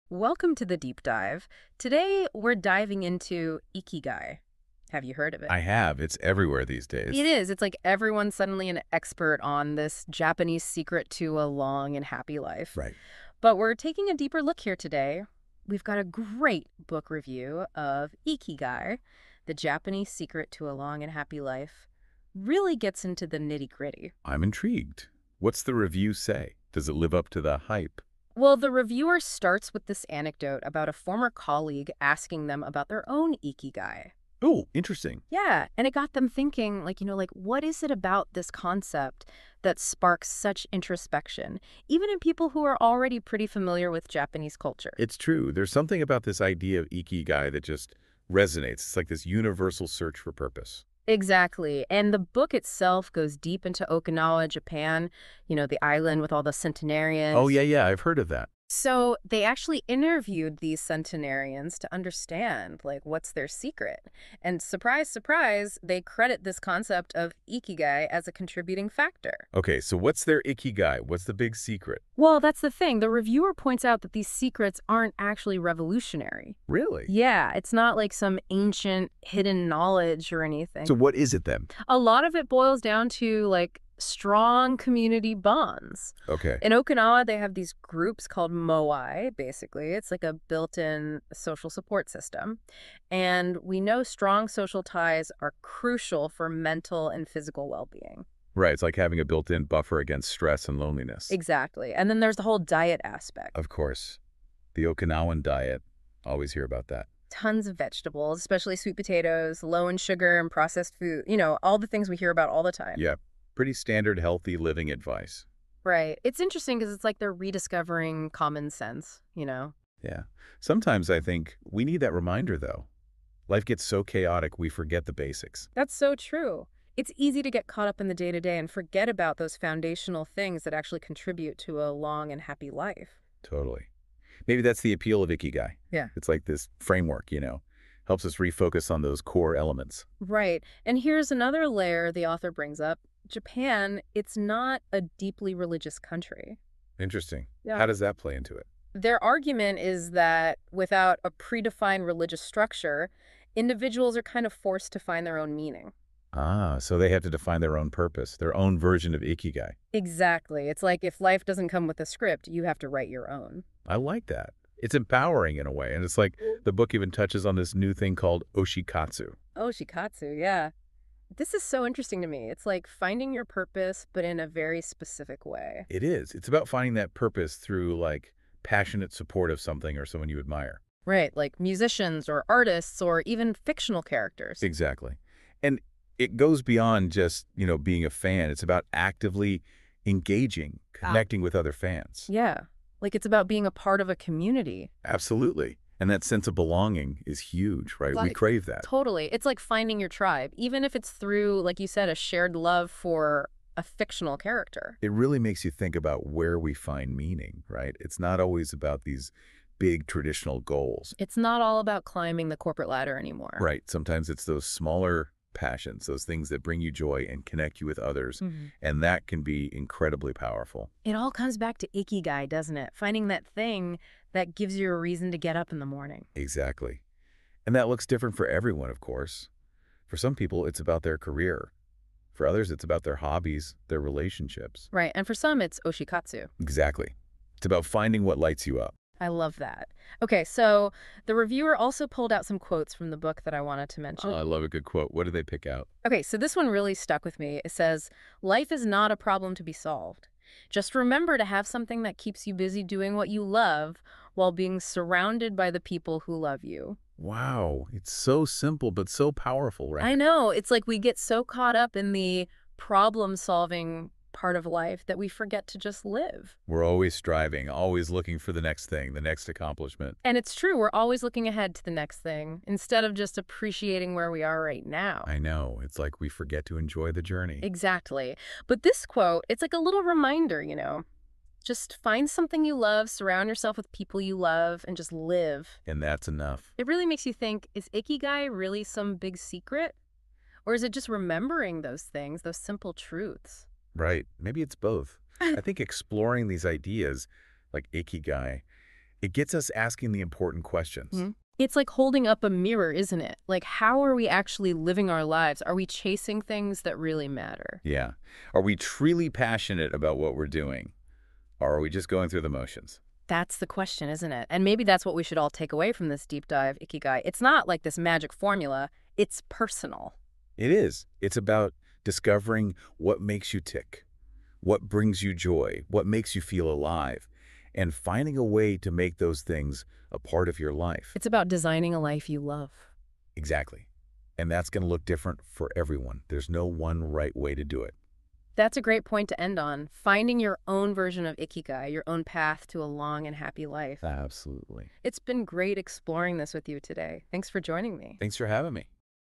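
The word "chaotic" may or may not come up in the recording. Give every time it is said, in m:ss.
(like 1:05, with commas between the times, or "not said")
2:04.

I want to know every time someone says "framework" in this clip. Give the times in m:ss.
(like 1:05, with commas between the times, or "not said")
2:16.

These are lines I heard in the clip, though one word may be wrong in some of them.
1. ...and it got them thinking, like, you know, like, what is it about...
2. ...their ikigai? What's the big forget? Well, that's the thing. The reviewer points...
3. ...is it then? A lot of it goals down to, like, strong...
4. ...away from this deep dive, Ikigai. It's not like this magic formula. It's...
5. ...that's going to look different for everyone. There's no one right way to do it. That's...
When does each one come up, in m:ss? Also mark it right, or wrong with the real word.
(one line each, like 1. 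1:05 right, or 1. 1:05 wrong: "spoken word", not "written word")
1. 0:35 right
2. 1:10 wrong: "secret", not "forget"
3. 1:21 wrong: "boils", not "goals"
4. 5:15 right
5. 5:34 right.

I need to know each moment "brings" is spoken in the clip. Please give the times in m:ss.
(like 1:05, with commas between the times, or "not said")
2:22, 3:36, 5:24.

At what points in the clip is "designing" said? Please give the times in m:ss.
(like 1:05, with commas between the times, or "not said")
5:31.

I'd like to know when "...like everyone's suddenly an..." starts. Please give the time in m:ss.
0:07.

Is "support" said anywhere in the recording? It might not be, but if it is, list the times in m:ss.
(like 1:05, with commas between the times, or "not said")
1:31, 2:59.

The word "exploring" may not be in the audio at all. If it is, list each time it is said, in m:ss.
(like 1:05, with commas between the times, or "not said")
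4:55, 5:45.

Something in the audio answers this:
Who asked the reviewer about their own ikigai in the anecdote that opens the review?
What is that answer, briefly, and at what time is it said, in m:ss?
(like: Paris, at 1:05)
a former colleague, at 0:30.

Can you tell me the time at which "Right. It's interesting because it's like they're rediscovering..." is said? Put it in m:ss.
1:55.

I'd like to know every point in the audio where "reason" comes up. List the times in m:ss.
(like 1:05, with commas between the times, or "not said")
3:45.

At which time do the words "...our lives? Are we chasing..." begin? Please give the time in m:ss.
5:05.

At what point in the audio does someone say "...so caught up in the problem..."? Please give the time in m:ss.
4:21.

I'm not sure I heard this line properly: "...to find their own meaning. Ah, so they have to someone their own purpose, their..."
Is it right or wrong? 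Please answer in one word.
wrong.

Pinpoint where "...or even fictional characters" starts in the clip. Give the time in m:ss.
3:03.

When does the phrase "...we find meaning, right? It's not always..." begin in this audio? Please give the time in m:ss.
3:26.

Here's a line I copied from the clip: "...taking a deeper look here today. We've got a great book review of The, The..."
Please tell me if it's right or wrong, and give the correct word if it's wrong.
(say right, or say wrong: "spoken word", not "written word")
wrong: "Ikigai", not "The".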